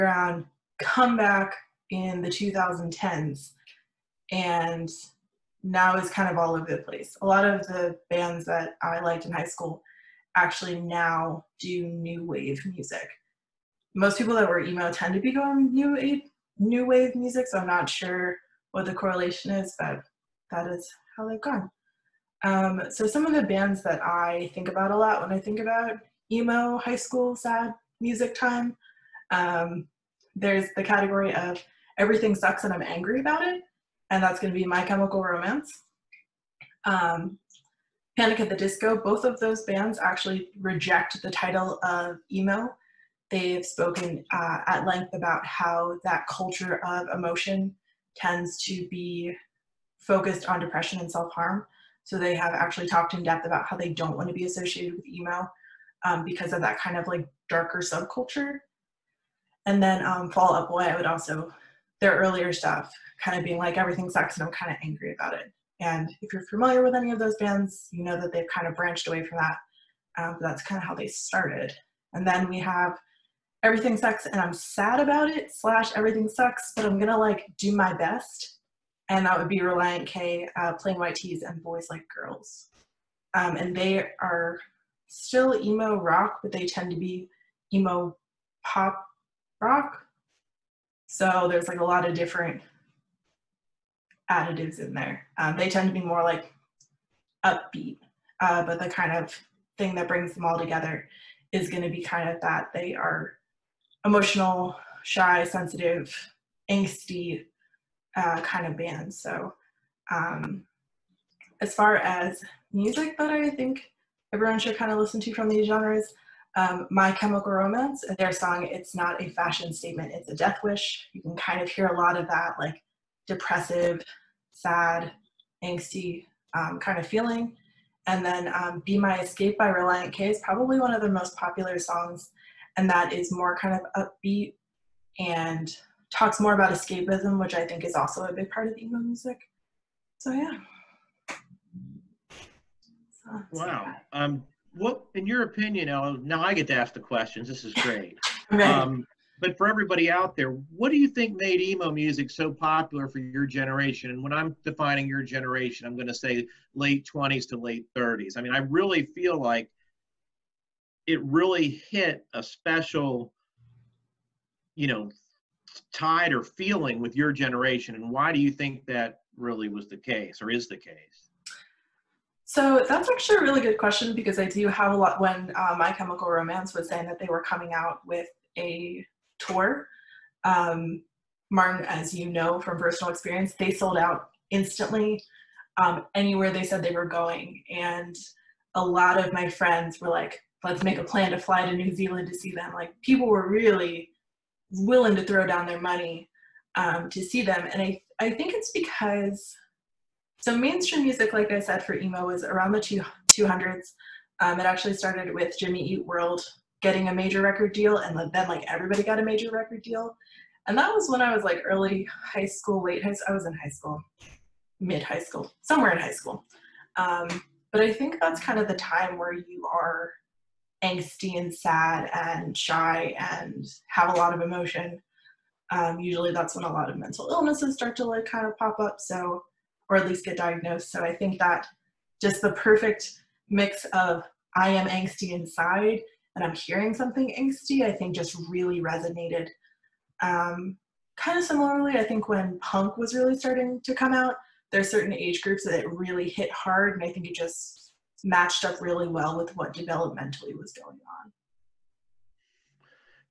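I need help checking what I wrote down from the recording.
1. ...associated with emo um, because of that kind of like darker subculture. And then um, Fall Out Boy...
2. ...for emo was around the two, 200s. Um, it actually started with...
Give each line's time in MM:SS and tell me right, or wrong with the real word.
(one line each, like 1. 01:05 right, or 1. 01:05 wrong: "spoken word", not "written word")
1. 00:54 right
2. 03:21 right.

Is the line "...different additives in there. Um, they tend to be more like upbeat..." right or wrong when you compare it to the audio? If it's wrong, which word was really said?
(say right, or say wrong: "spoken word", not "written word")
right.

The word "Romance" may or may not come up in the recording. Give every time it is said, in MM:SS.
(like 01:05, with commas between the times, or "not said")
00:35, 01:57, 02:56.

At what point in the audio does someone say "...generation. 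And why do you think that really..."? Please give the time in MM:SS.
02:47.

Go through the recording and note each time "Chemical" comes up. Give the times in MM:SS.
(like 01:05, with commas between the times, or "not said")
00:34, 01:57, 02:55.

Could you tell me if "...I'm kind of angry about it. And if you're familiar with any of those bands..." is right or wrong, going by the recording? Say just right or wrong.
right.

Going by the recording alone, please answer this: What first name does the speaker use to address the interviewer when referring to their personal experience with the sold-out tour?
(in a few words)
Martin.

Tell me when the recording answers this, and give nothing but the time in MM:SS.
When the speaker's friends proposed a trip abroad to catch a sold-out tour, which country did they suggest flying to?
03:11.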